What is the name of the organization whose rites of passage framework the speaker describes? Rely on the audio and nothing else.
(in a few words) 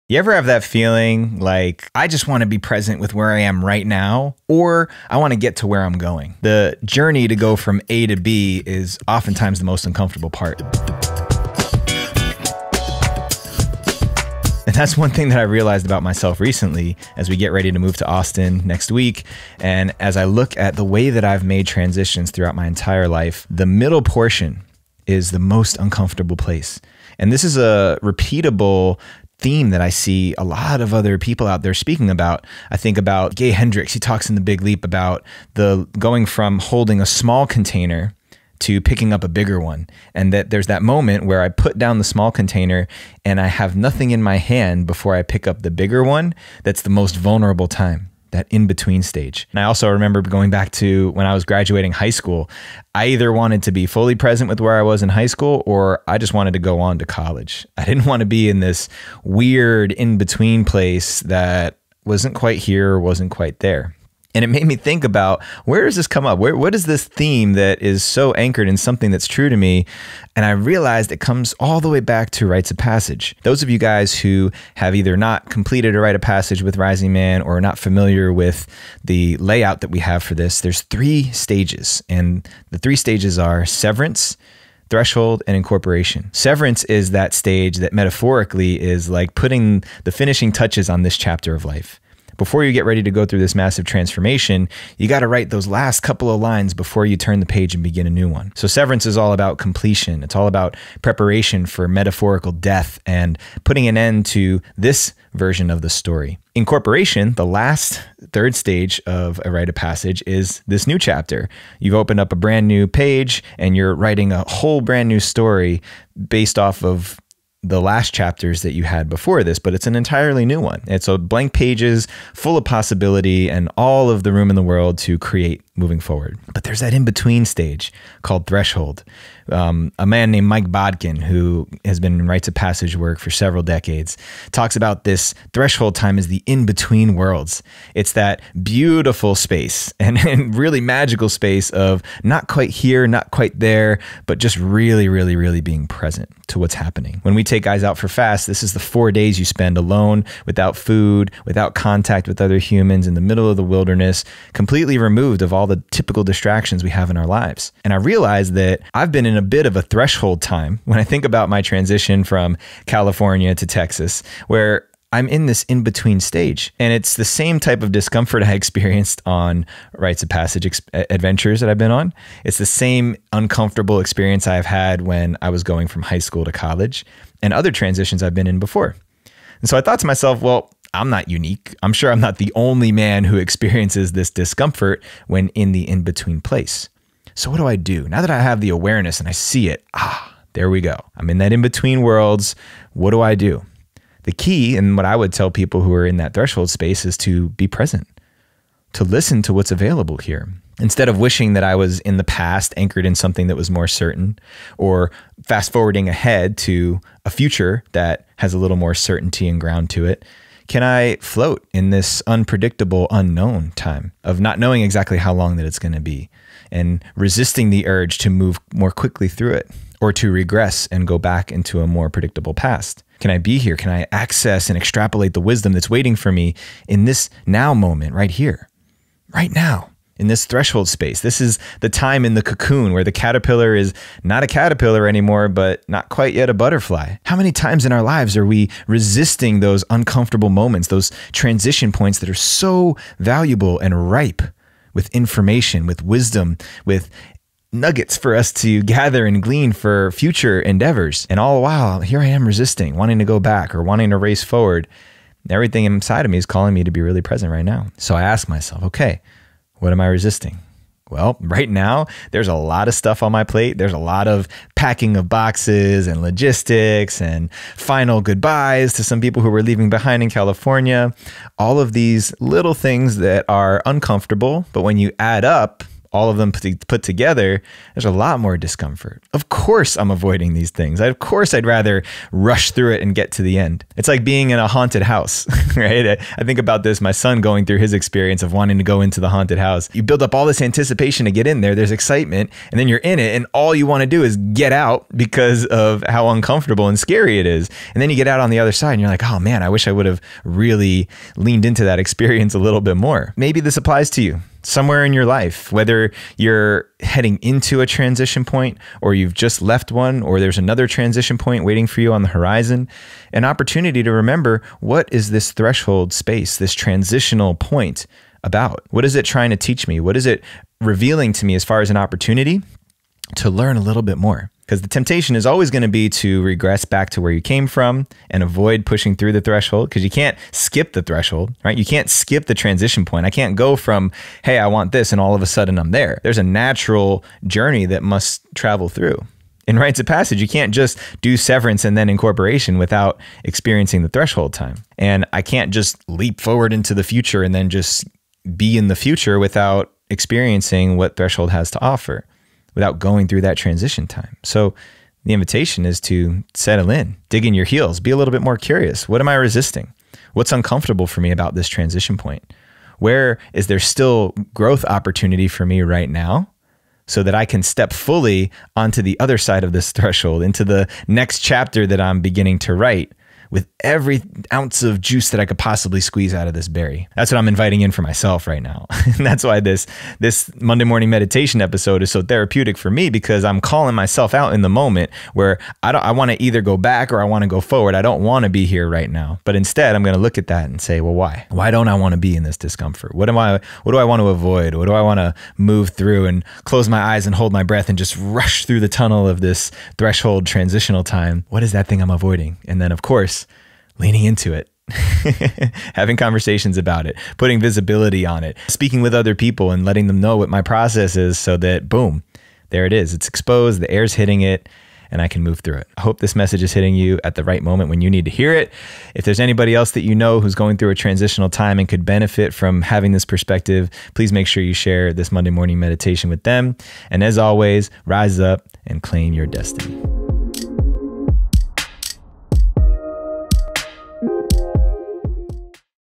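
Rising Man.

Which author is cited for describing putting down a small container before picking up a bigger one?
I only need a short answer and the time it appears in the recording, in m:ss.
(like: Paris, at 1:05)
Gay Hendricks, at 0:33.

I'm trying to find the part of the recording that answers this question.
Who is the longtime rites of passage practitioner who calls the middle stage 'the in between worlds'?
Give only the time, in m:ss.
2:10.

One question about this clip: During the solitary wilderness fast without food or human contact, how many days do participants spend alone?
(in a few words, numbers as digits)
4.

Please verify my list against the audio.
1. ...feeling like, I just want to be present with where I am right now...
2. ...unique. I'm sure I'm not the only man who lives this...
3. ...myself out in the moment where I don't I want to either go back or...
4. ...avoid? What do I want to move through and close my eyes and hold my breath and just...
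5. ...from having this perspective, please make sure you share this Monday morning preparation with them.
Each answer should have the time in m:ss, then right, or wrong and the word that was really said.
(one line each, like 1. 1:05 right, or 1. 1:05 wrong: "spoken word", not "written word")
1. 0:00 right
2. 3:01 wrong: "experiences", not "lives"
3. 6:23 right
4. 6:34 right
5. 7:02 wrong: "meditation", not "preparation".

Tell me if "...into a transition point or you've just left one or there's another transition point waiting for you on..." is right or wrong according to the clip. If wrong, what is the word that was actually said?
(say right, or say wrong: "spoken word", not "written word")
right.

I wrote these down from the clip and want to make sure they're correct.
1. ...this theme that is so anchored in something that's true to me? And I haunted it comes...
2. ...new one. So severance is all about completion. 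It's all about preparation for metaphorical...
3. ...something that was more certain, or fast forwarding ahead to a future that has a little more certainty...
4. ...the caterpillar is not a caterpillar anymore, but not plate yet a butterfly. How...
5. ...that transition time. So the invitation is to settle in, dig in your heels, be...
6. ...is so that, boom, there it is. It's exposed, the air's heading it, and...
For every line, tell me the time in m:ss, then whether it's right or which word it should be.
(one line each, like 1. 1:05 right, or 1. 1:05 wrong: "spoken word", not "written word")
1. 1:06 wrong: "realized", not "haunted"
2. 1:38 right
3. 3:23 right
4. 3:53 wrong: "quite", not "plate"
5. 5:53 right
6. 6:51 wrong: "hitting", not "heading".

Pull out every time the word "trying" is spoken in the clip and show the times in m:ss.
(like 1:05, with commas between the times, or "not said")
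5:19.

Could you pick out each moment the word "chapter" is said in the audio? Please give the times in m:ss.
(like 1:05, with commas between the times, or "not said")
1:31, 1:50, 1:58, 6:11.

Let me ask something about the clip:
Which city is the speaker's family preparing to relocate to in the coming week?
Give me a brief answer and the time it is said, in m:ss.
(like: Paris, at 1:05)
Austin, at 0:18.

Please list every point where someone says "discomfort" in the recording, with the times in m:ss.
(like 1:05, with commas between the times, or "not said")
2:47, 3:04, 4:38, 6:32.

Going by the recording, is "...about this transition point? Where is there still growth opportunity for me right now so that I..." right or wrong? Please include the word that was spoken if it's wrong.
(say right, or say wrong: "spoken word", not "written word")
right.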